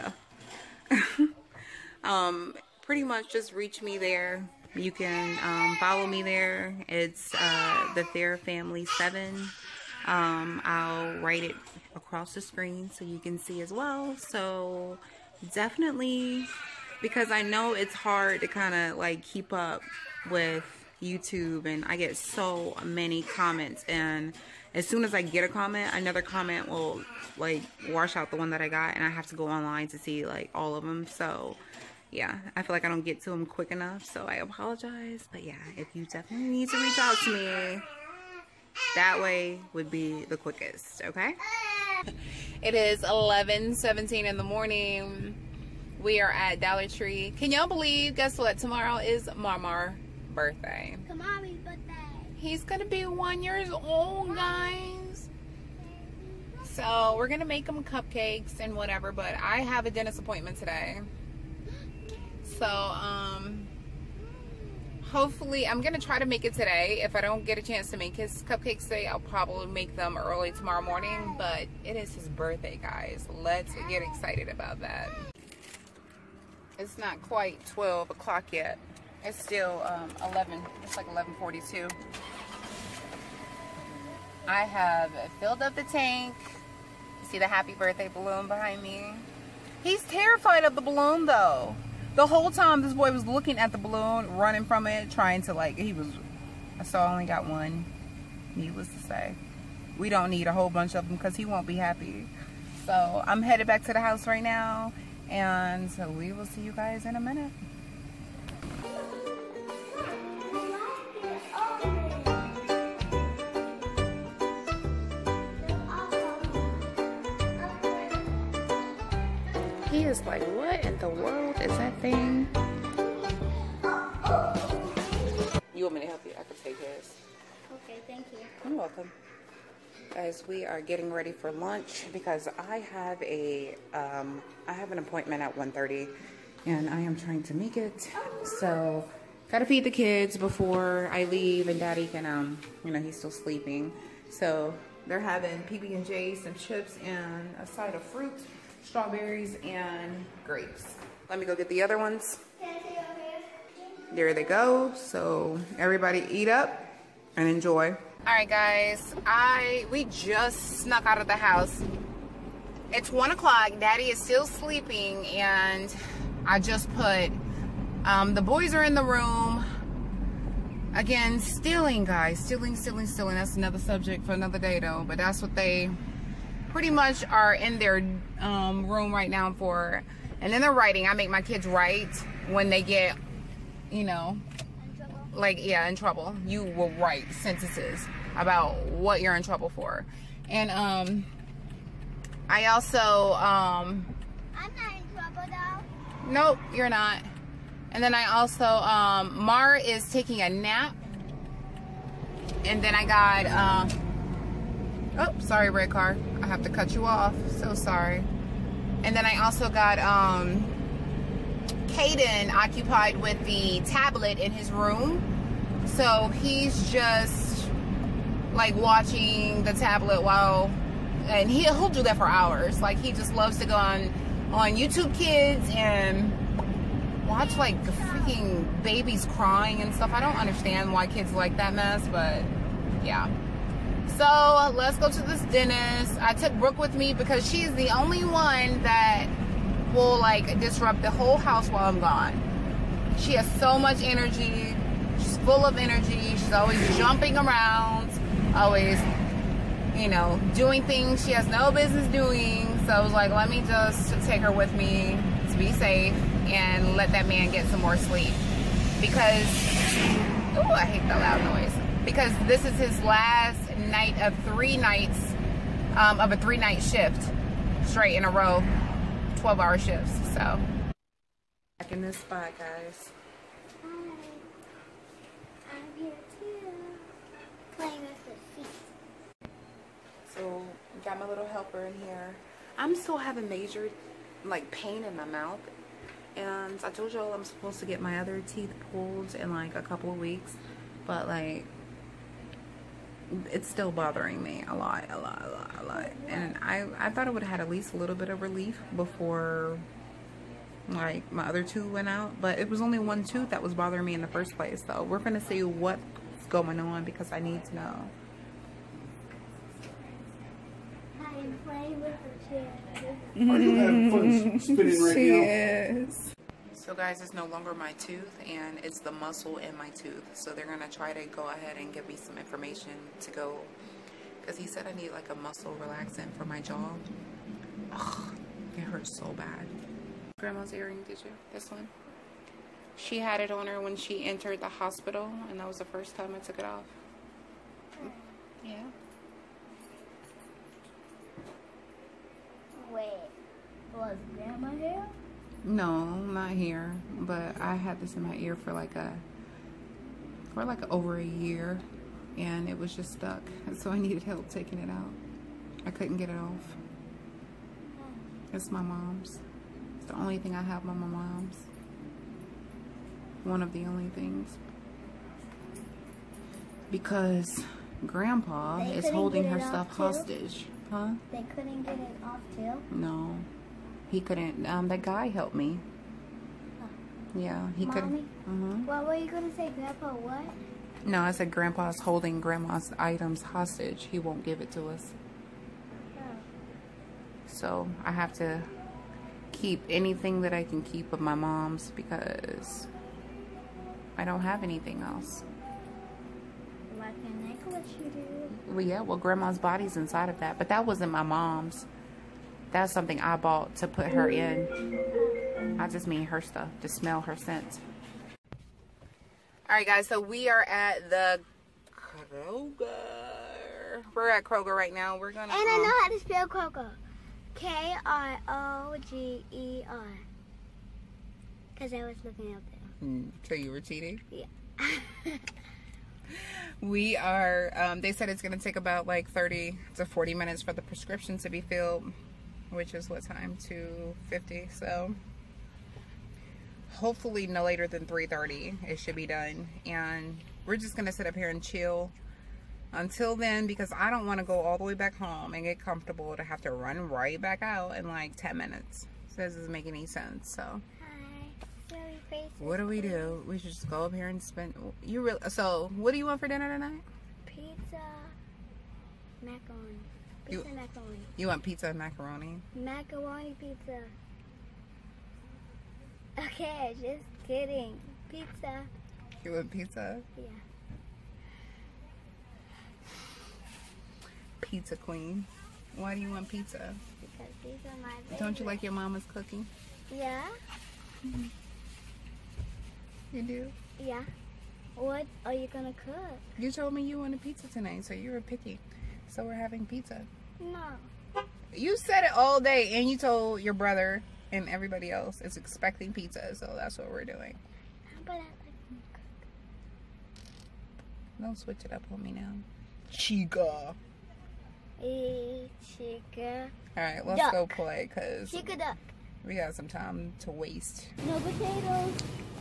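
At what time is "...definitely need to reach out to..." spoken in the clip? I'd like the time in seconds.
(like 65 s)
36 s.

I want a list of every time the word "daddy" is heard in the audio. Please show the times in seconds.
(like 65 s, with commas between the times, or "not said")
141 s, 163 s.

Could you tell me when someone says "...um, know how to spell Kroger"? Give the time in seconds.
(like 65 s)
415 s.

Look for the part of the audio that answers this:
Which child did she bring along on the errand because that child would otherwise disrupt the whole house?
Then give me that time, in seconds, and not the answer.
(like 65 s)
236 s.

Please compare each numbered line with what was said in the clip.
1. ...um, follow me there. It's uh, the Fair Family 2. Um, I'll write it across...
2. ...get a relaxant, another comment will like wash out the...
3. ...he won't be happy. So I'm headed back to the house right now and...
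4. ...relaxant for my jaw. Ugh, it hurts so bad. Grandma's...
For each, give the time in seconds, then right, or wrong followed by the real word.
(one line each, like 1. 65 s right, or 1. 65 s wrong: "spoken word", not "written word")
1. 5 s wrong: "7", not "2"
2. 25 s wrong: "comment", not "relaxant"
3. 101 s right
4. 325 s right.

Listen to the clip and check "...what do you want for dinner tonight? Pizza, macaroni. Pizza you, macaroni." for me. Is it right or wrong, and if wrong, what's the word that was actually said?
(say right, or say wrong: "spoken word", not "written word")
right.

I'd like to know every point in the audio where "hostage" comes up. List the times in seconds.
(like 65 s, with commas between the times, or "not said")
370 s, 383 s.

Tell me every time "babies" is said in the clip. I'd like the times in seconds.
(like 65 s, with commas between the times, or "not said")
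228 s.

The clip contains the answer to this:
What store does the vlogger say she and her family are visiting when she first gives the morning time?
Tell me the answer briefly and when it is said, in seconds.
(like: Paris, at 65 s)
Dollar Tree, at 46 s.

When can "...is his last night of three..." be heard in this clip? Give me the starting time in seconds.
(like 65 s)
262 s.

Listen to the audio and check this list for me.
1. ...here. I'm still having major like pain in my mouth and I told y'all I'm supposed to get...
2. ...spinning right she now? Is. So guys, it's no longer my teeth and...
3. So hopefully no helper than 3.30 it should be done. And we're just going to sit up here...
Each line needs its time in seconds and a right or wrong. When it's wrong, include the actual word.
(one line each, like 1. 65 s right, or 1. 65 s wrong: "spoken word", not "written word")
1. 282 s right
2. 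314 s wrong: "tooth", not "teeth"
3. 434 s wrong: "later", not "helper".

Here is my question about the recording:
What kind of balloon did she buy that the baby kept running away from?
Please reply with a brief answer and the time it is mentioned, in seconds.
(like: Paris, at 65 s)
happy birthday balloon, at 87 s.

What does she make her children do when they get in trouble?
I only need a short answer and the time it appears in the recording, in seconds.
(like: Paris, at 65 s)
write sentences, at 186 s.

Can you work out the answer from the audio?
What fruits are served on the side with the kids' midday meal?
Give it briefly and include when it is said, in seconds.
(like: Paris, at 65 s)
strawberries and grapes, at 148 s.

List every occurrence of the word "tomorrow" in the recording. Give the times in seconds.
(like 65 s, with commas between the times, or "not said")
48 s, 70 s.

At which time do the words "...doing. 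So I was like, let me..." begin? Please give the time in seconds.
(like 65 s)
252 s.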